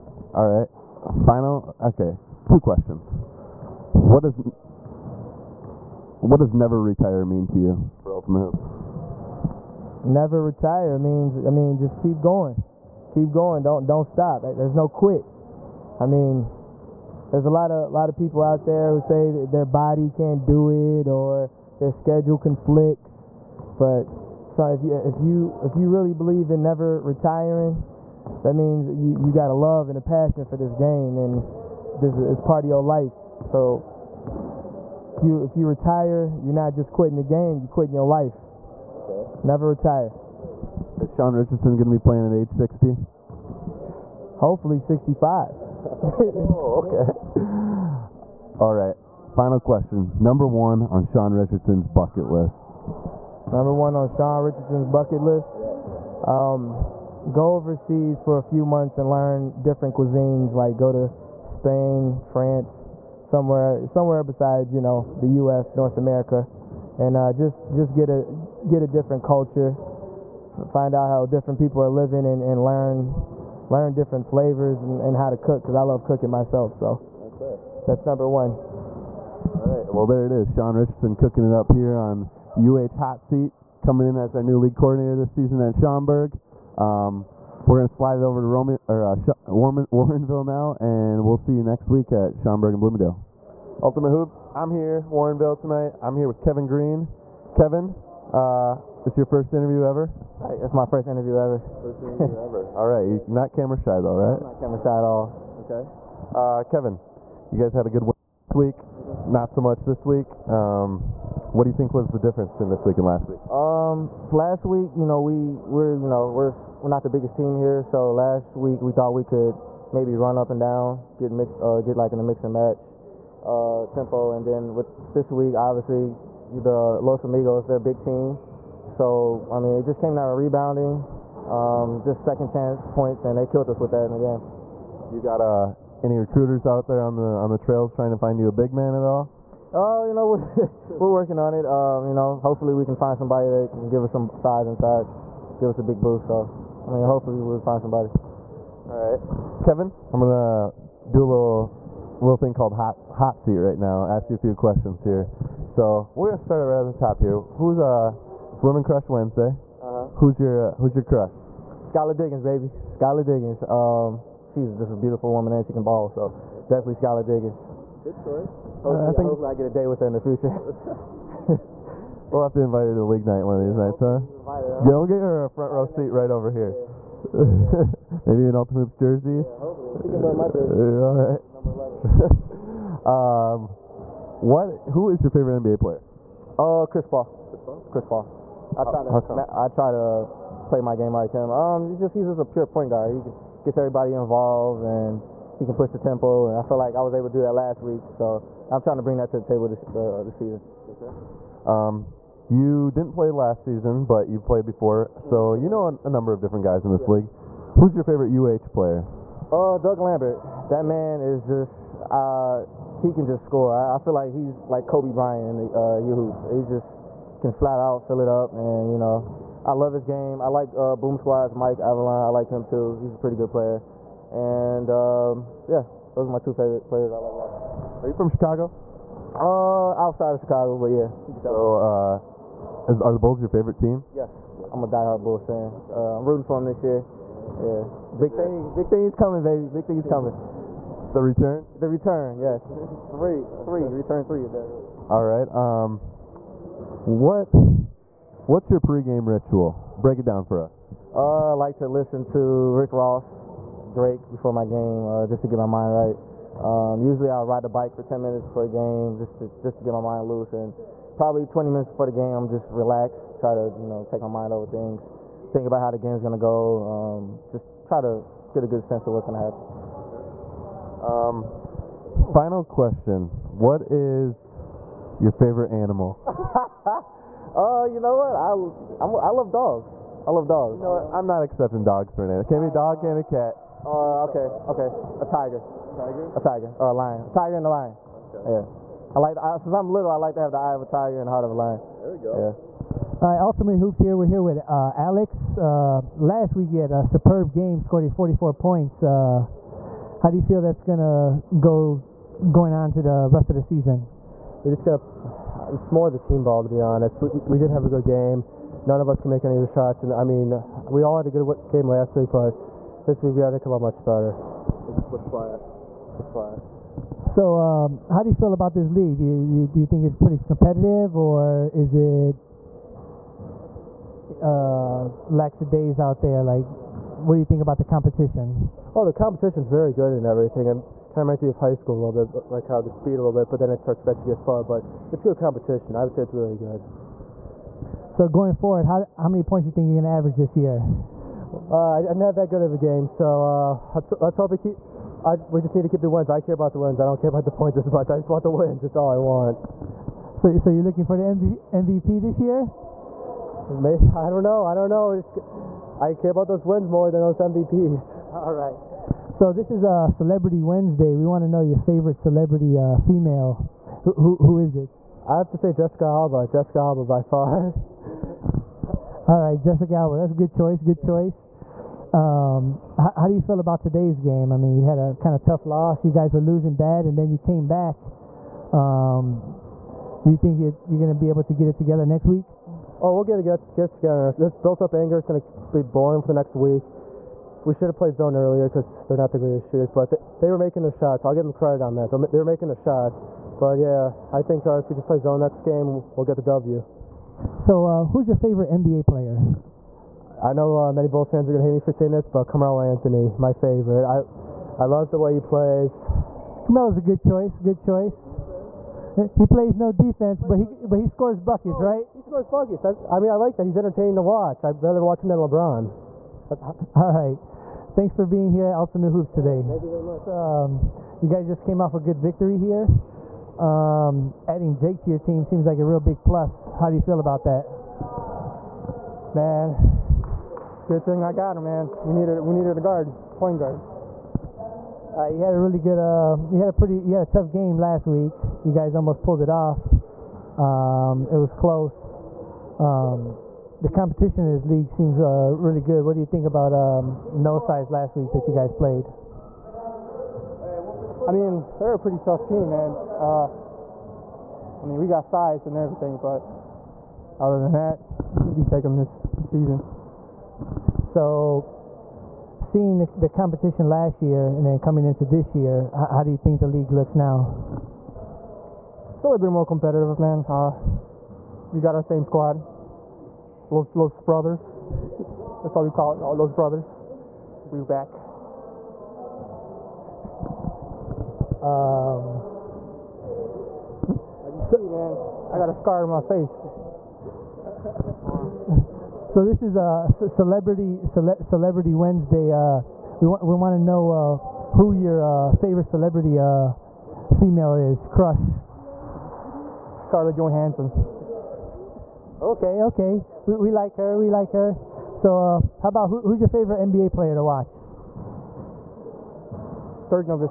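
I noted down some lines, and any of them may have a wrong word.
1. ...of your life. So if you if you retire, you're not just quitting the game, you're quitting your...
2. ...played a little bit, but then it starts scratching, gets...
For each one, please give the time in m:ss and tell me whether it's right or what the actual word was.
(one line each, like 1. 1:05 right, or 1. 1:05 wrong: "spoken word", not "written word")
1. 0:32 right
2. 5:32 wrong: "speed", not "played".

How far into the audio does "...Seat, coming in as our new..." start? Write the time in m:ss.
1:23.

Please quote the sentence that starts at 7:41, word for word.
So, seeing the, the competition last year and then coming into this year, how, how, do you think the league looks now?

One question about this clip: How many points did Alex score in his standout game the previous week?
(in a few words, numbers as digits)
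44.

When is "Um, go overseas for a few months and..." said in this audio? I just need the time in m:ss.
0:56.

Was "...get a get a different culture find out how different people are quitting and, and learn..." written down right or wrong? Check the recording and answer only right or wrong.
wrong.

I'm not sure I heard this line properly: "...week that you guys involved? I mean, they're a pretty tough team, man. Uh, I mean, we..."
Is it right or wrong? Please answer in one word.
wrong.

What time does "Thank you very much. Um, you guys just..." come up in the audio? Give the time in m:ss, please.
6:59.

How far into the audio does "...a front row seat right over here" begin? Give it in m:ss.
2:55.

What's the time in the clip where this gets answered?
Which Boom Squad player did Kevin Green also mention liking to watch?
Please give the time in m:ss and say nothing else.
3:41.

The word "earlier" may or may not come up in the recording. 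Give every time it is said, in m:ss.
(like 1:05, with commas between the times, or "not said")
6:28.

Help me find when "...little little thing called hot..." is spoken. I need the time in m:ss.
2:31.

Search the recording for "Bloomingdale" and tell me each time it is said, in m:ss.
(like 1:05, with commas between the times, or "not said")
1:32.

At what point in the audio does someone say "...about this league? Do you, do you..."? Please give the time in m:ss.
5:18.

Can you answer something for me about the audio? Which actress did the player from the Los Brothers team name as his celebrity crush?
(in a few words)
Scarlett Johansson.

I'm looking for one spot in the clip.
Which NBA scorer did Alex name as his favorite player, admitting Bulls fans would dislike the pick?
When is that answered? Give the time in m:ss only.
6:42.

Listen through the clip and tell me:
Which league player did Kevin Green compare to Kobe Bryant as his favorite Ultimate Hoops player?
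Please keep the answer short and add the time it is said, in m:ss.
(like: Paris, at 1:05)
Doug Lambert, at 3:29.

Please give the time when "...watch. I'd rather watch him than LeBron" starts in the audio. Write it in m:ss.
6:54.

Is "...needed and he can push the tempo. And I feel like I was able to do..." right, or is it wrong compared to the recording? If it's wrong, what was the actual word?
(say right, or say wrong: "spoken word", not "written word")
wrong: "involved", not "needed".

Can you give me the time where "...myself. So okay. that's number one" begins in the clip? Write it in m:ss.
1:16.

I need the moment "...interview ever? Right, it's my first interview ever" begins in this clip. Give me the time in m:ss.
1:39.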